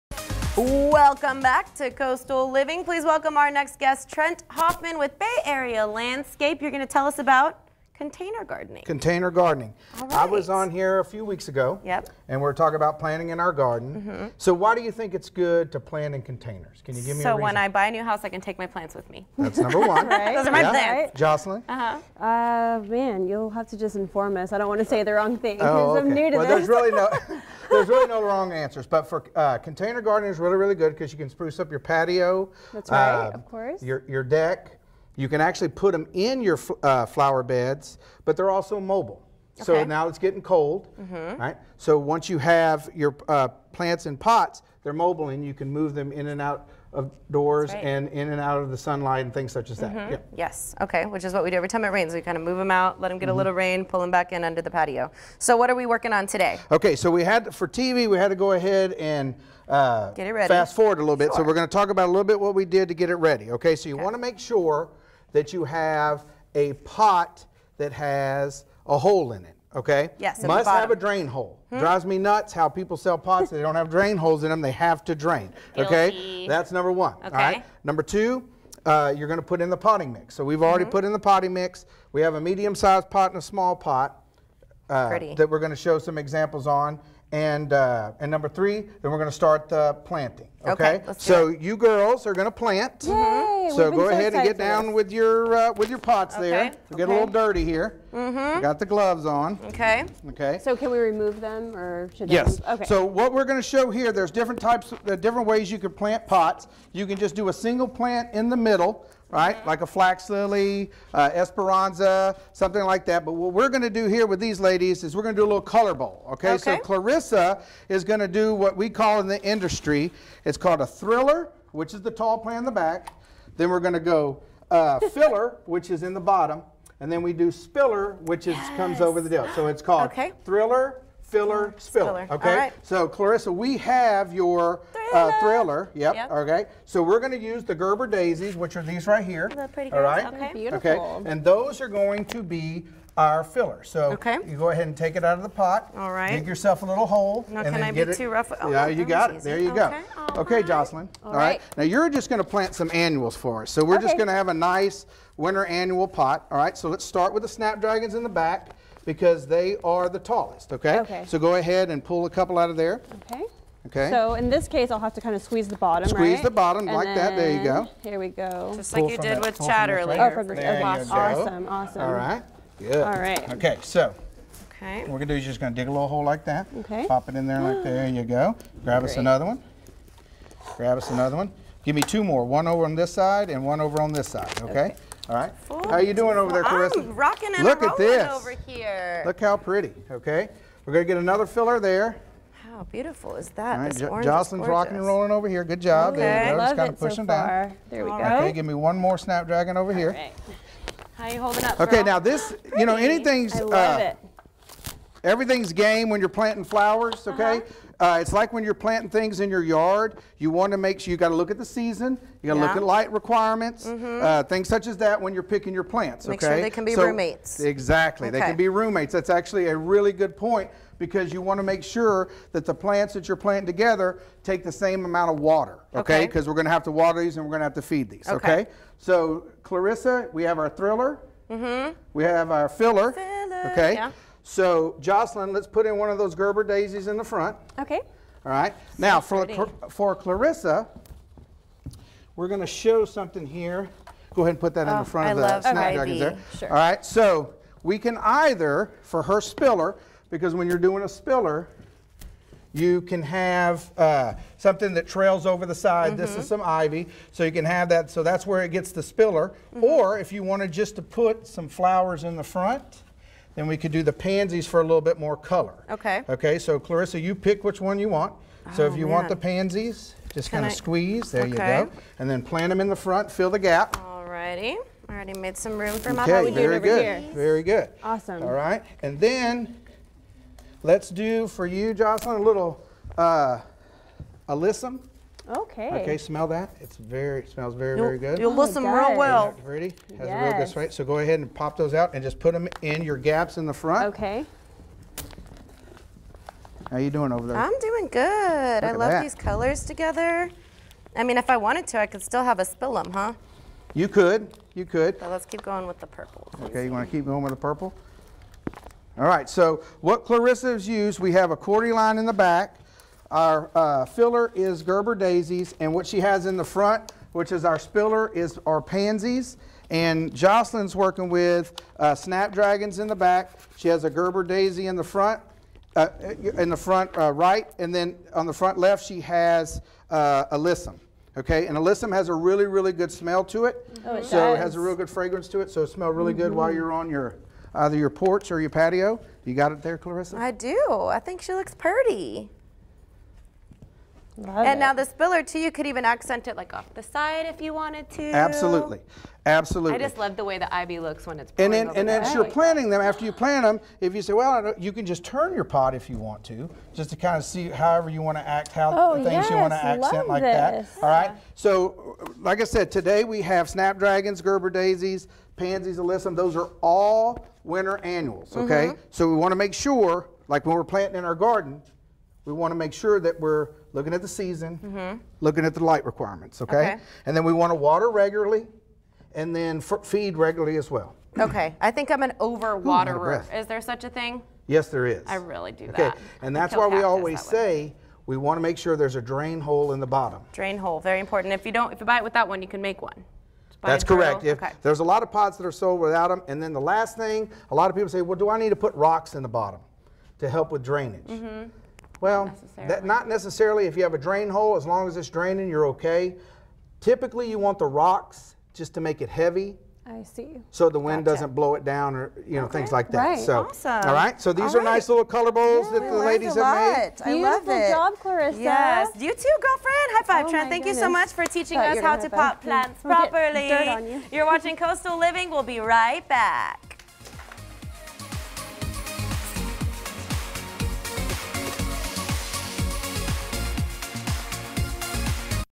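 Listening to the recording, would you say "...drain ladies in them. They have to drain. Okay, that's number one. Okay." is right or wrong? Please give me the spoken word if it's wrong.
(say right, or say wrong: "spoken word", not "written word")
wrong: "holes", not "ladies".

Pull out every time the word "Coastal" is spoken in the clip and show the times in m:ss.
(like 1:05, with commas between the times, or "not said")
0:01, 7:04.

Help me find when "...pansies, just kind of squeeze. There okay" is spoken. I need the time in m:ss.
4:29.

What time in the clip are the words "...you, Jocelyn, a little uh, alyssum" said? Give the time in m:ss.
4:41.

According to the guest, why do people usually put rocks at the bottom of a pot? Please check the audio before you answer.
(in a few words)
to make it heavy.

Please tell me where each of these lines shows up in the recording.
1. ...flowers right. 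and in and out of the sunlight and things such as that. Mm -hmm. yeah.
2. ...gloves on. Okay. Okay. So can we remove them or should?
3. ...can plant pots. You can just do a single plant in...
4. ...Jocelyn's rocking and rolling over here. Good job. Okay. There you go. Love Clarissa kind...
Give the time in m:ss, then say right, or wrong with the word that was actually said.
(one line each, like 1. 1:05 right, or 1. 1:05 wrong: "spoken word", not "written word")
1. 0:47 wrong: "doors", not "flowers"
2. 1:38 right
3. 1:45 right
4. 3:14 wrong: "Just", not "Clarissa".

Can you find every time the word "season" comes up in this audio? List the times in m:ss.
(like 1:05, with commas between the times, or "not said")
3:31, 6:14.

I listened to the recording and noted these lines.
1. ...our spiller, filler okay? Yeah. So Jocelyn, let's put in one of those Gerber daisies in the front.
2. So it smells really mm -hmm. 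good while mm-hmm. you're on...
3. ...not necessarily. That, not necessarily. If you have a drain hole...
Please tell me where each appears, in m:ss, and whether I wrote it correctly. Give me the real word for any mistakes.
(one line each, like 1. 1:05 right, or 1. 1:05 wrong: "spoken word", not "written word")
1. 3:52 wrong: "filler", not "spiller"
2. 5:35 right
3. 6:42 right.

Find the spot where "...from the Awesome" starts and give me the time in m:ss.
2:50.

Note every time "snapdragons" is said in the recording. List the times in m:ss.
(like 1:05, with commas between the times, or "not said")
2:37, 3:19, 4:05, 5:22, 6:03.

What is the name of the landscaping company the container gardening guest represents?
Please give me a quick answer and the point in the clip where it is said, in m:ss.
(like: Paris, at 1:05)
Bay Area Landscape, at 0:05.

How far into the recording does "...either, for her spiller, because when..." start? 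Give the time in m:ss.
4:08.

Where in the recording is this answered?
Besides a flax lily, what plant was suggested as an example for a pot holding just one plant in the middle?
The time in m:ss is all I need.
1:51.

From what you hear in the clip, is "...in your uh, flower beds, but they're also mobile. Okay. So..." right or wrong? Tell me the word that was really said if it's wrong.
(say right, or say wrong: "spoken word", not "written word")
right.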